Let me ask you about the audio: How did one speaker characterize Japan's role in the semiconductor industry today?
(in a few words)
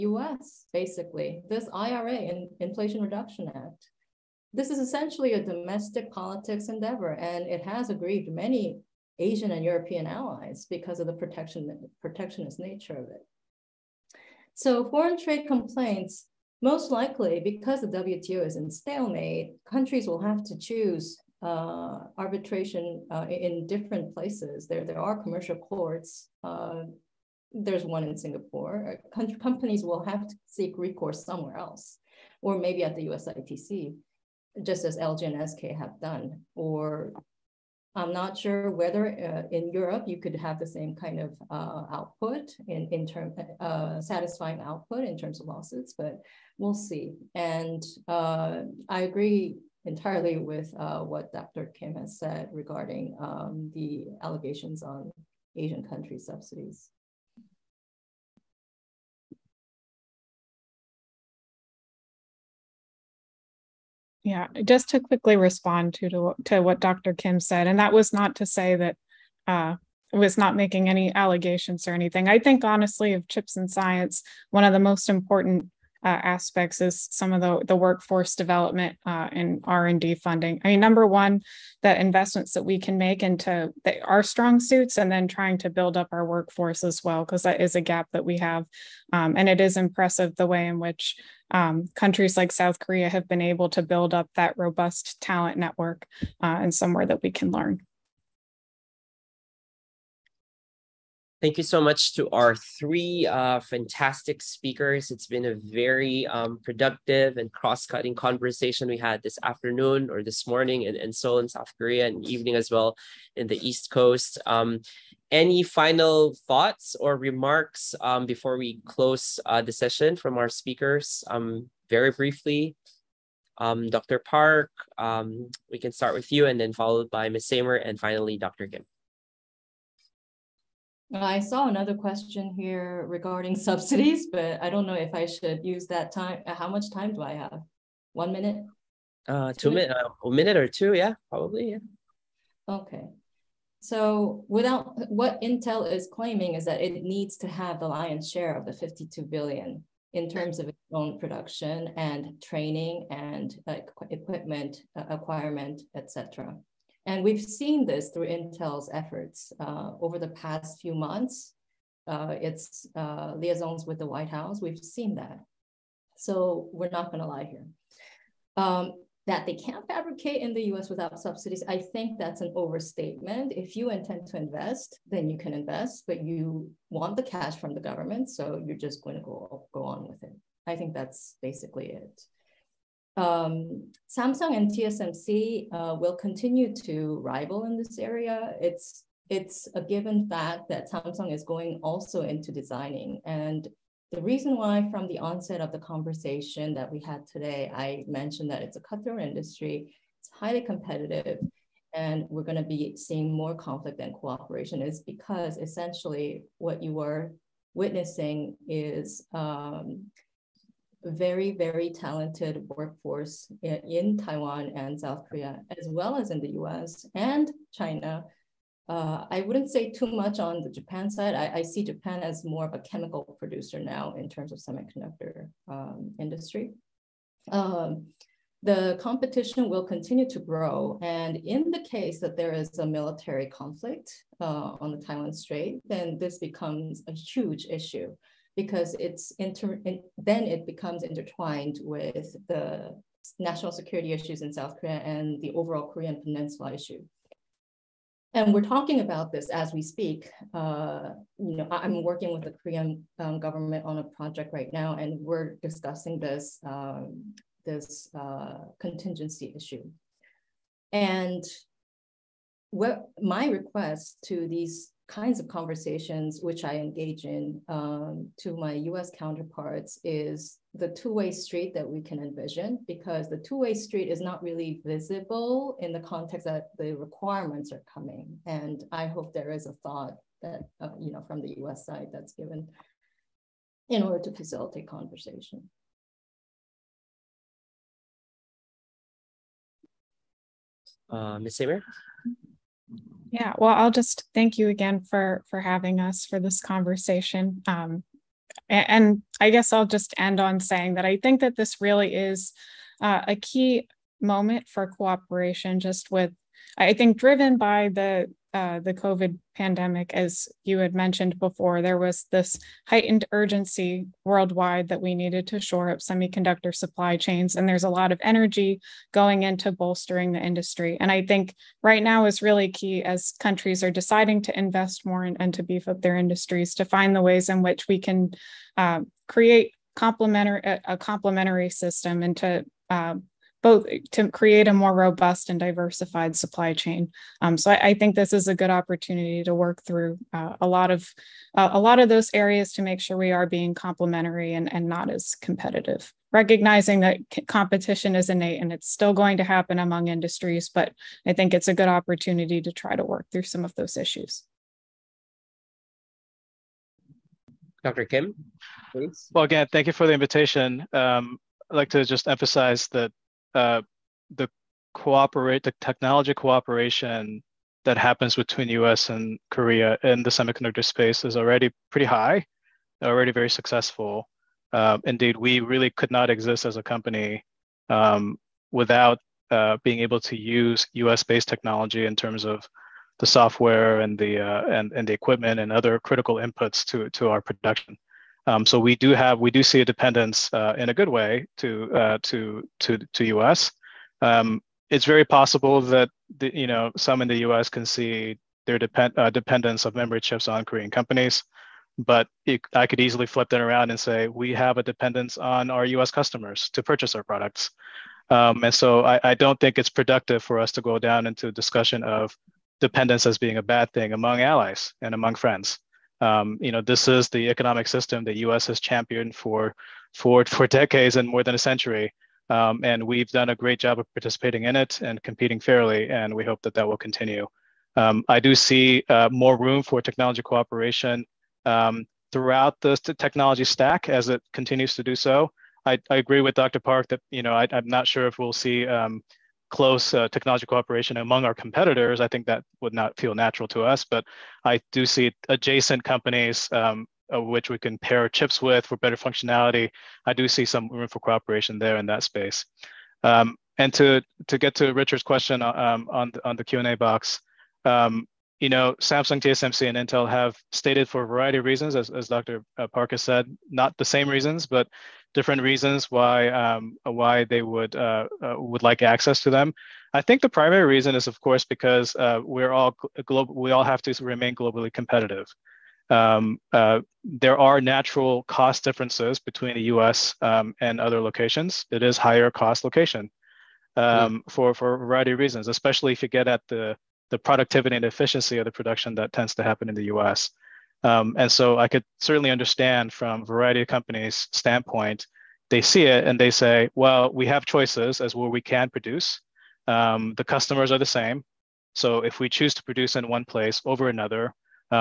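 chemical producer.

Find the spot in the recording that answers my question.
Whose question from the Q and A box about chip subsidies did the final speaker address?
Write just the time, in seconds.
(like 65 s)
454 s.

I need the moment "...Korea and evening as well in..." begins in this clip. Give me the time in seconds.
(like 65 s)
111 s.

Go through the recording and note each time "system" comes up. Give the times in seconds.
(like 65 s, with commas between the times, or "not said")
331 s, 417 s.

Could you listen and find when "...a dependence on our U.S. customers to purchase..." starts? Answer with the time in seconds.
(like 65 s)
404 s.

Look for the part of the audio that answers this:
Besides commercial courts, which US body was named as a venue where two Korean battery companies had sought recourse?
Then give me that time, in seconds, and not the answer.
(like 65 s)
33 s.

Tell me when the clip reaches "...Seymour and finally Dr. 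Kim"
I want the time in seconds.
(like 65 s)
127 s.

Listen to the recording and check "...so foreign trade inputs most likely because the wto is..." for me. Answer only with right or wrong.
wrong.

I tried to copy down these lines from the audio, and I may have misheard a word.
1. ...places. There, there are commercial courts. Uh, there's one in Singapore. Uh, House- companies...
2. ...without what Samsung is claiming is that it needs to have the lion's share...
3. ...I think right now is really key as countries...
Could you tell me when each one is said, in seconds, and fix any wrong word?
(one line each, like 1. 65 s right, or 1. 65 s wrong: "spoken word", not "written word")
1. 24 s wrong: "Com", not "House"
2. 144 s wrong: "Intel", not "Samsung"
3. 321 s right.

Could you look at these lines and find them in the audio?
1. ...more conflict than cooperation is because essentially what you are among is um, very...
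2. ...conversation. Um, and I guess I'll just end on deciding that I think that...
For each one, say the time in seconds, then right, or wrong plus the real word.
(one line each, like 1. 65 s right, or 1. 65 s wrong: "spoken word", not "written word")
1. 203 s wrong: "witnessing", not "among"
2. 296 s wrong: "saying", not "deciding".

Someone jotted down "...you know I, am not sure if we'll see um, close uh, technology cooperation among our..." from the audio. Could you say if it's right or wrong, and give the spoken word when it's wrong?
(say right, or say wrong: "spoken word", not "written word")
right.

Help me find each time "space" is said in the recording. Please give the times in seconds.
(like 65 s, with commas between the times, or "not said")
370 s, 452 s.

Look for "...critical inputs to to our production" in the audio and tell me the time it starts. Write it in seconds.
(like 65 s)
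385 s.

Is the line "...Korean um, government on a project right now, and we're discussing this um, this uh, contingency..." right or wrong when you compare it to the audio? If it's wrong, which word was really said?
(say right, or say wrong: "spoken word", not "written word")
right.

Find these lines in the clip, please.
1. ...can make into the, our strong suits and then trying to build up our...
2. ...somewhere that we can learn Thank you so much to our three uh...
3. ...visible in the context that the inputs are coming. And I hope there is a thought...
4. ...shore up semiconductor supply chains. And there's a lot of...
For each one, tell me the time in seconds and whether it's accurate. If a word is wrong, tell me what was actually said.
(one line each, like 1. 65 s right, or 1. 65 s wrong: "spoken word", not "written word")
1. 82 s right
2. 96 s right
3. 274 s wrong: "requirements", not "inputs"
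4. 315 s right.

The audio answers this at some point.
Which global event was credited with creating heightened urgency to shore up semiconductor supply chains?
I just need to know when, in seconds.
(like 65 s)
308 s.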